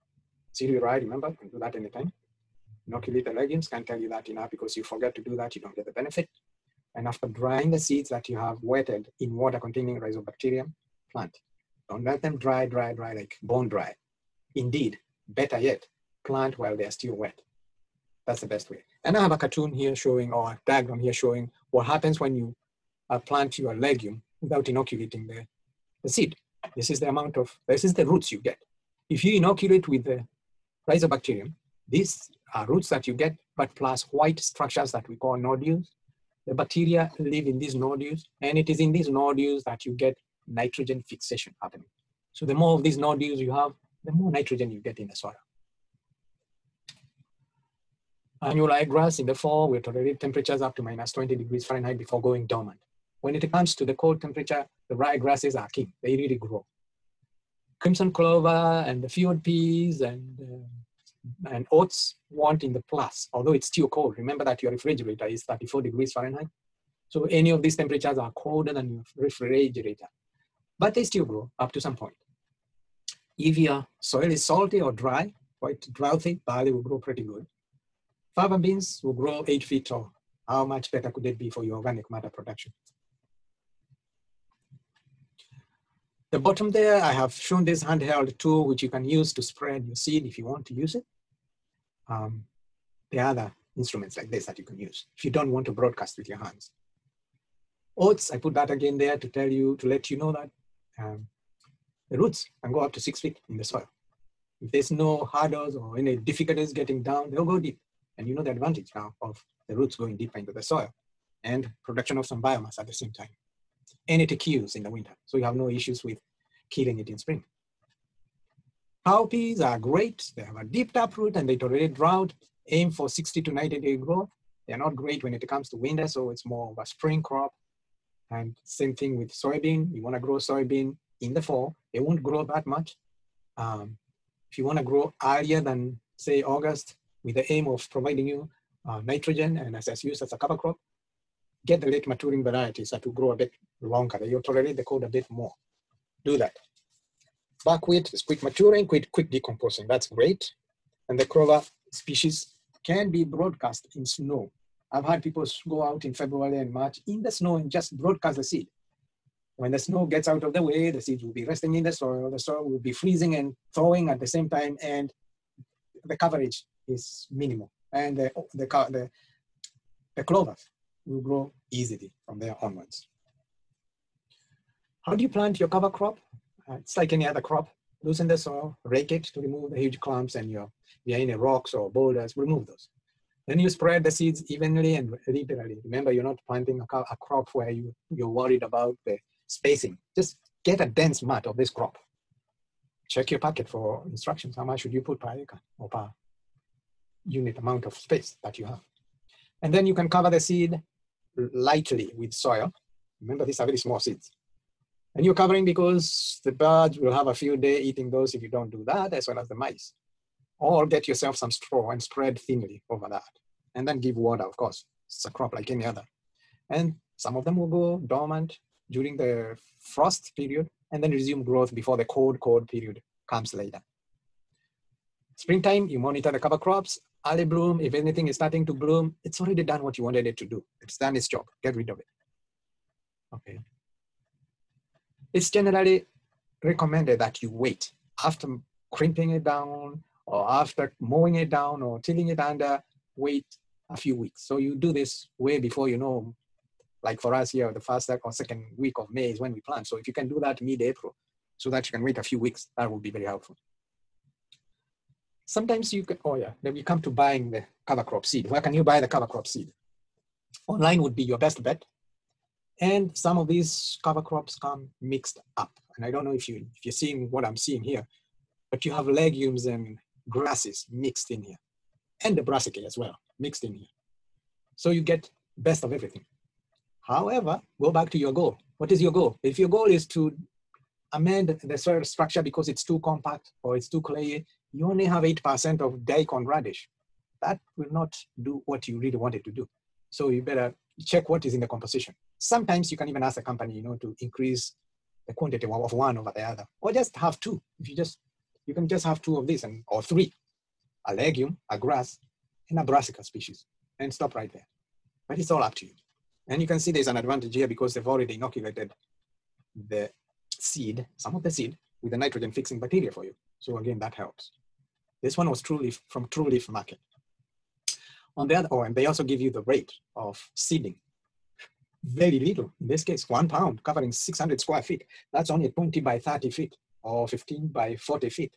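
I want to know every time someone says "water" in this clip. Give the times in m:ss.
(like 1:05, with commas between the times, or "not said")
0:09, 3:34.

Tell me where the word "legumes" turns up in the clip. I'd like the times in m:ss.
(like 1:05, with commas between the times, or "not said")
0:03, 0:23, 4:29, 5:01.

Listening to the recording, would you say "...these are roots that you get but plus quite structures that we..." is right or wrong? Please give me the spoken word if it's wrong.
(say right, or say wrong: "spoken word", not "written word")
wrong: "white", not "quite".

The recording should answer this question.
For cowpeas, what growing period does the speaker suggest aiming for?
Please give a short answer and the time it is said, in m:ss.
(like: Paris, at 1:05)
60 to 90 days, at 2:03.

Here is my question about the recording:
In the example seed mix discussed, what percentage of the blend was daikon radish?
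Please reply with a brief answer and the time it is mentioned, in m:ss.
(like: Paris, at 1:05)
8%, at 4:45.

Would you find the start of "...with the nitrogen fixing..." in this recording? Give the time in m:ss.
5:12.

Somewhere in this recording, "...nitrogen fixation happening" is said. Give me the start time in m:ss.
0:40.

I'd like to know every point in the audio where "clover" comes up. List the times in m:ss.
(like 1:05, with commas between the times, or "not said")
0:58, 2:31, 2:50.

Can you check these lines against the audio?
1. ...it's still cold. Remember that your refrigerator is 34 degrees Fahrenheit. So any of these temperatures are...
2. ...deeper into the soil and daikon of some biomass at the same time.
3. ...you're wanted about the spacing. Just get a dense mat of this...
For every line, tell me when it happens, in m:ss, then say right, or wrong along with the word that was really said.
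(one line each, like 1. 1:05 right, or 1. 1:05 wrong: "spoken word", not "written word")
1. 1:03 right
2. 1:50 wrong: "production", not "daikon"
3. 3:08 wrong: "worried", not "wanted".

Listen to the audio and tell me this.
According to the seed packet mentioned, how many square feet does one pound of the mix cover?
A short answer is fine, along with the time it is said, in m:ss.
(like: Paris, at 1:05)
600 square feet, at 5:24.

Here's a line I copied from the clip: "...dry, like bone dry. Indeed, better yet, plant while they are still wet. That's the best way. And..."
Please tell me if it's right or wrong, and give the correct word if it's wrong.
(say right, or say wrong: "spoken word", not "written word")
right.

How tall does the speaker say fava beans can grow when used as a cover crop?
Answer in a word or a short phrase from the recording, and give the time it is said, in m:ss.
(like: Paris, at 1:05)
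8 feet, at 1:19.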